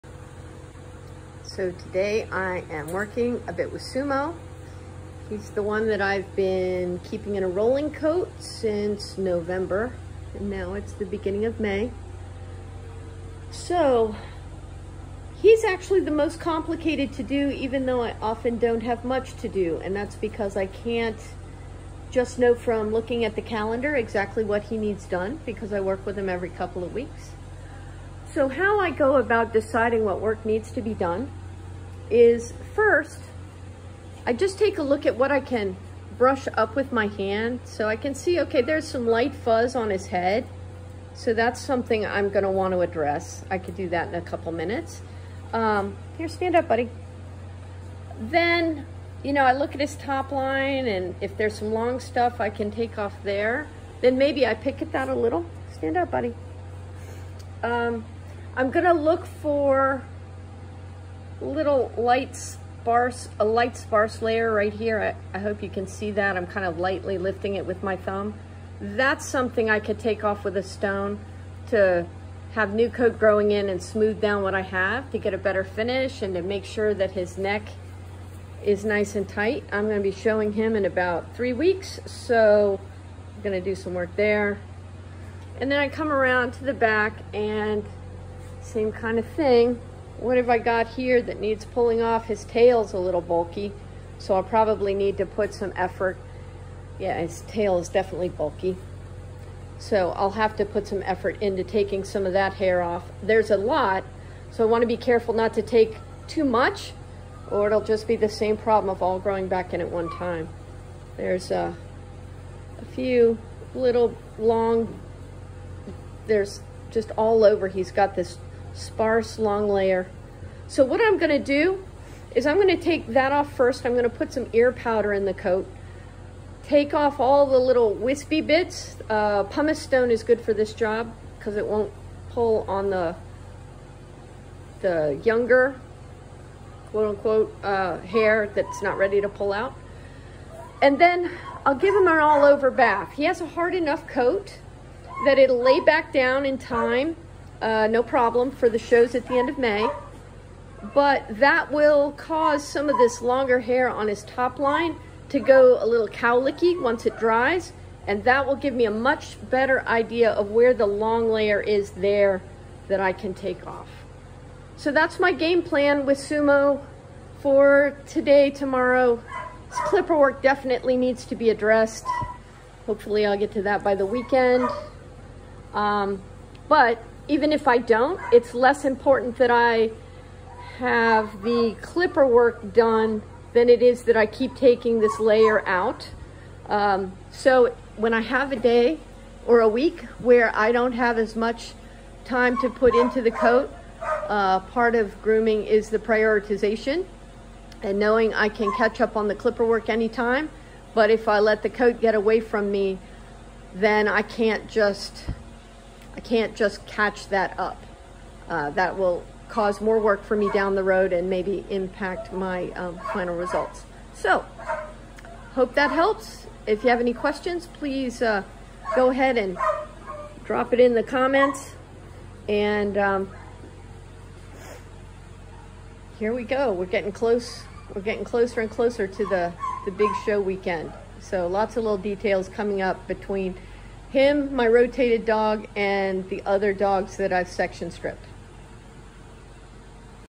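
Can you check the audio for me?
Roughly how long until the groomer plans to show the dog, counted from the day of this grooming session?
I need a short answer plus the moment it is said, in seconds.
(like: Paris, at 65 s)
3 weeks, at 81 s.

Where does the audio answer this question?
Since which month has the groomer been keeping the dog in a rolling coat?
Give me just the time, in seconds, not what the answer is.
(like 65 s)
9 s.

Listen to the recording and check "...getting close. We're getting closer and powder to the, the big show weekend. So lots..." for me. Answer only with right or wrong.
wrong.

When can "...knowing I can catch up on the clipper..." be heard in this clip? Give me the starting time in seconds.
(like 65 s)
197 s.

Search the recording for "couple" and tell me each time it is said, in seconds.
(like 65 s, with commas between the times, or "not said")
26 s, 44 s.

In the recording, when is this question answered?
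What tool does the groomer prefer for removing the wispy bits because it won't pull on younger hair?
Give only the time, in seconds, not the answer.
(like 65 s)
129 s.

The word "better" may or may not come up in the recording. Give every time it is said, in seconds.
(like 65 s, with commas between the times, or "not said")
75 s, 159 s.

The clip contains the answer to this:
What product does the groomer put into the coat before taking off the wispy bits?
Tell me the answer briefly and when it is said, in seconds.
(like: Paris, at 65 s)
Ear powder, at 124 s.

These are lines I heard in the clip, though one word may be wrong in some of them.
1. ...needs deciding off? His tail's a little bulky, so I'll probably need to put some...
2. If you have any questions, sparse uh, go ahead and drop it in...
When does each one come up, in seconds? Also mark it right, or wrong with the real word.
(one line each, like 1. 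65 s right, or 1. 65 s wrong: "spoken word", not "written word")
1. 91 s wrong: "pulling", not "deciding"
2. 216 s wrong: "please", not "sparse".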